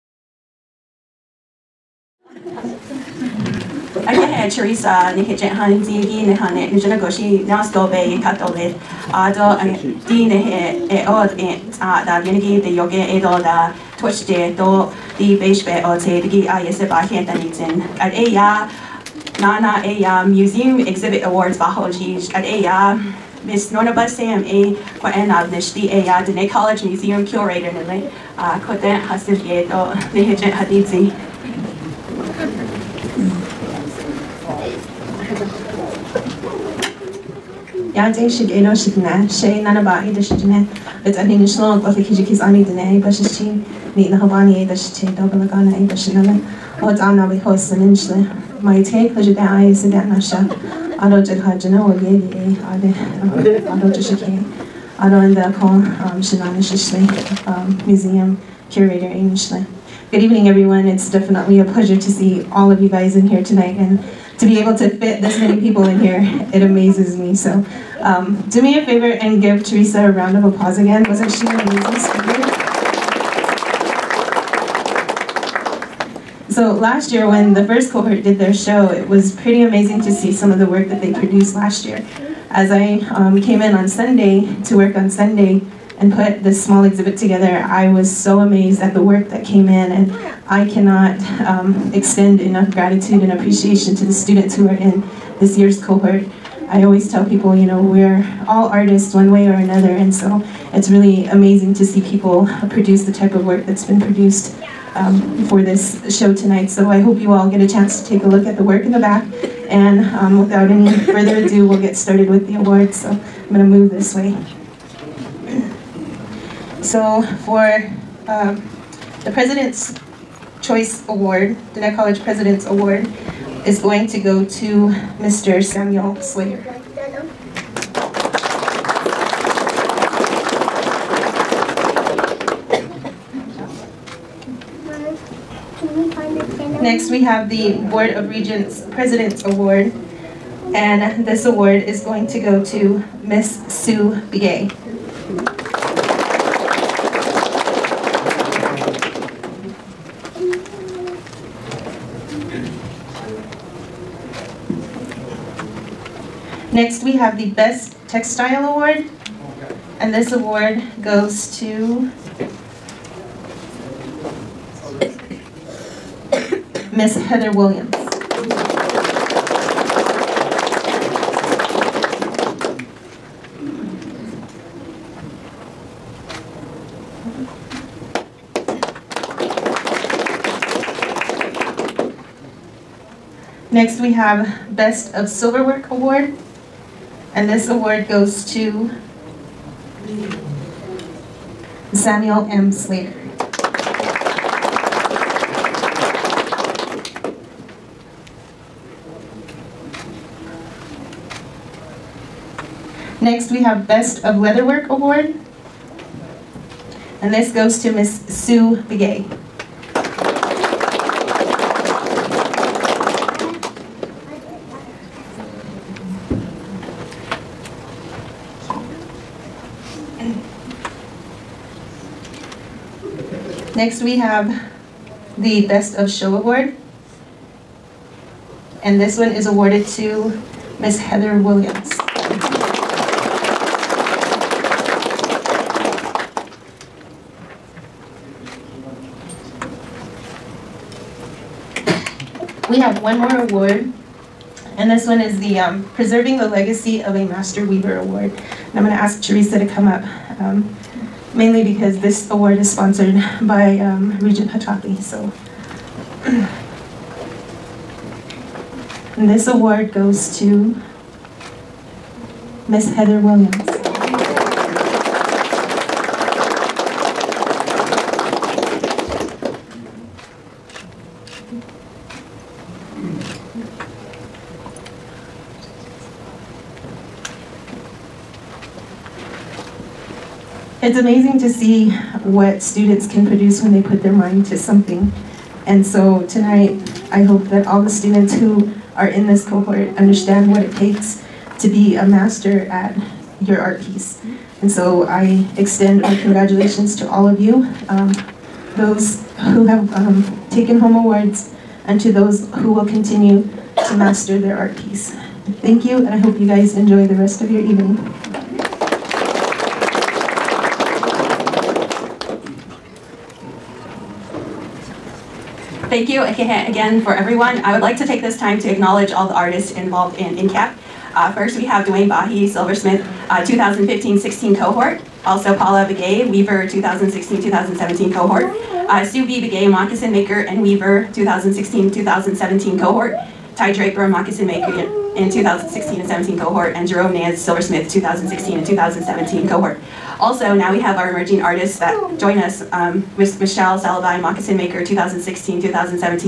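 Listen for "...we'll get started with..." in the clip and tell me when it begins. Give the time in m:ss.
1:51.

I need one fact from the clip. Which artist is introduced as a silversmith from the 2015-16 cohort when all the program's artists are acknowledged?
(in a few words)
Dwayne Bahi.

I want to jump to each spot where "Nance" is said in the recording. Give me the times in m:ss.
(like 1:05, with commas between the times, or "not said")
5:37.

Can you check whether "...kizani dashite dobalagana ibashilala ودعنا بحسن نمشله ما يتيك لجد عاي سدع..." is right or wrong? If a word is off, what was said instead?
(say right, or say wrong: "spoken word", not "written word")
wrong: "nahabani", not "kizani".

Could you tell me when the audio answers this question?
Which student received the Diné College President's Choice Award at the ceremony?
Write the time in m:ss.
2:05.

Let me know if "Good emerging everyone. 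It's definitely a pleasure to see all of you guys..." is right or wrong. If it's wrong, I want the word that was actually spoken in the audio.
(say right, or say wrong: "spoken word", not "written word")
wrong: "evening", not "emerging".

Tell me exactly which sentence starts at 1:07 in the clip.
So um, do me a favor and give Teresa a round of applause again.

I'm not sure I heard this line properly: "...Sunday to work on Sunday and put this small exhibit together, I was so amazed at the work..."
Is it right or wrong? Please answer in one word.
right.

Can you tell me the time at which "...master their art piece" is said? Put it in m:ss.
5:03.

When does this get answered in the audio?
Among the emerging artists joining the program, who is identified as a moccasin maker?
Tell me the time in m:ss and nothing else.
5:43.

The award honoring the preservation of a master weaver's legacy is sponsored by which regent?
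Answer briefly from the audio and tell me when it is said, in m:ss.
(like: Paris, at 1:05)
Regent Hachakli, at 4:14.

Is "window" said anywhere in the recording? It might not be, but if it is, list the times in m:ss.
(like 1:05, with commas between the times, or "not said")
not said.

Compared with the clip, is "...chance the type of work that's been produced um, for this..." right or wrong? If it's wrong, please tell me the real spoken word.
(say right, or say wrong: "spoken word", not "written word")
wrong: "produce", not "chance".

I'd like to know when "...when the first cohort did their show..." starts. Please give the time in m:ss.
1:17.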